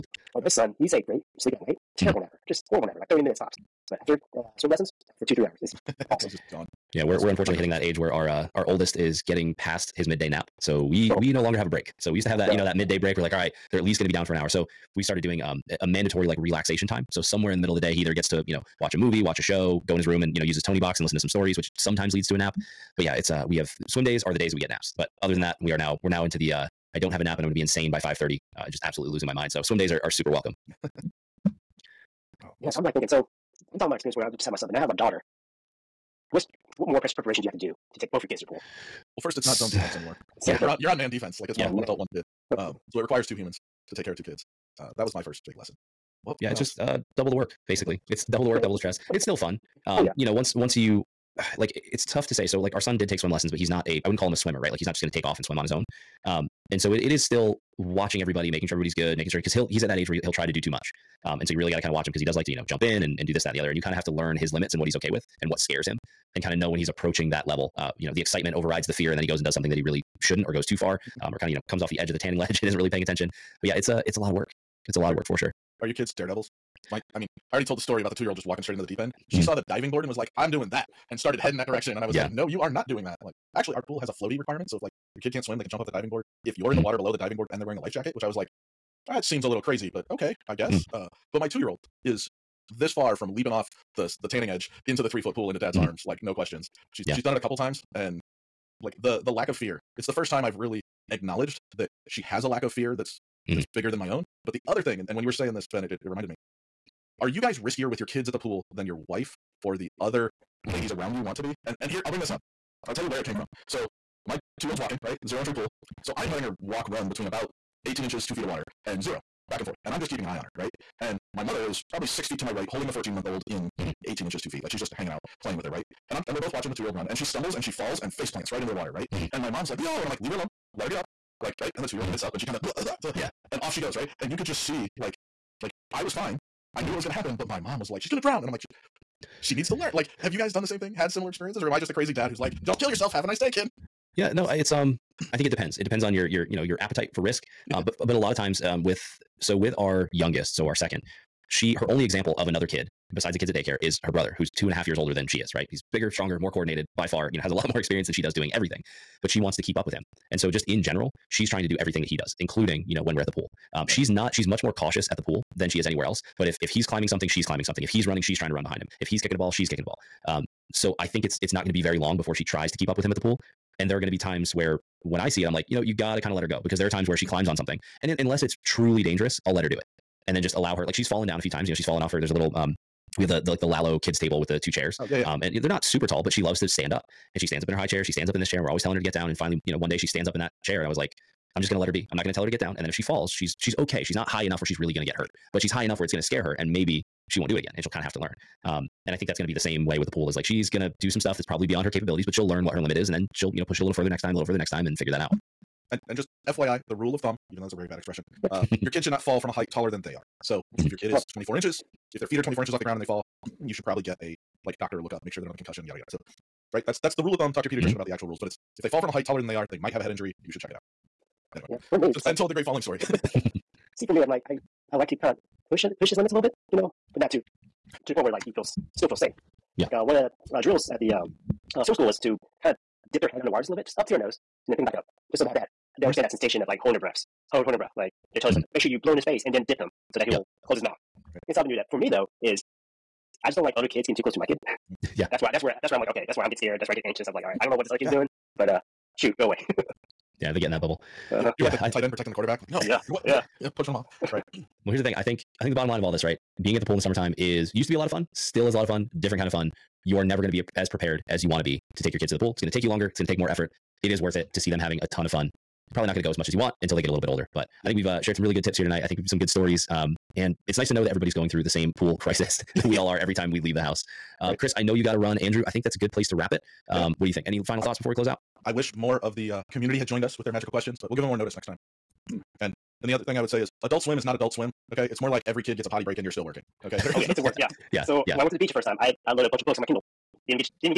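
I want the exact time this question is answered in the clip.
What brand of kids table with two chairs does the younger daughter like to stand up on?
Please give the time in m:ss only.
3:03.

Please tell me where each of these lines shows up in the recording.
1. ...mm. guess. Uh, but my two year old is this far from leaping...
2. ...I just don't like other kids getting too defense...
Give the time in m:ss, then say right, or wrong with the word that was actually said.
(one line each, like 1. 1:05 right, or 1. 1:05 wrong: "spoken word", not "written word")
1. 1:30 right
2. 4:03 wrong: "close", not "defense".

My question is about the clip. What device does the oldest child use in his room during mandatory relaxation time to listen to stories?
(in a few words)
Toniebox.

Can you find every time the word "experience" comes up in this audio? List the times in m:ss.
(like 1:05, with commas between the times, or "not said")
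0:33, 2:21, 2:37.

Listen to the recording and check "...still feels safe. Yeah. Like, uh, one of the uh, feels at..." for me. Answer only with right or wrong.
wrong.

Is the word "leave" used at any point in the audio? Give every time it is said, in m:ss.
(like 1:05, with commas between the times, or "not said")
2:10, 4:33.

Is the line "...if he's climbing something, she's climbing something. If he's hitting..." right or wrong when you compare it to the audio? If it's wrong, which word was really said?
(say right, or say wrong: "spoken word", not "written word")
wrong: "running", not "hitting".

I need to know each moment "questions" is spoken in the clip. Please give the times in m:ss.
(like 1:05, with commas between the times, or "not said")
1:36, 4:40.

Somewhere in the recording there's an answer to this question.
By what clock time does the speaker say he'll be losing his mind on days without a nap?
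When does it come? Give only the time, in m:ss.
0:27.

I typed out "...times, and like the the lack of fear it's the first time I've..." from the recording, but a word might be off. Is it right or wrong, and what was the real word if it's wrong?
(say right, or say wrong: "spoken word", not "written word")
right.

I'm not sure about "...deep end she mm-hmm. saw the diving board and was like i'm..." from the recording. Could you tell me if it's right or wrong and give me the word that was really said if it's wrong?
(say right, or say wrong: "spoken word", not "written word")
right.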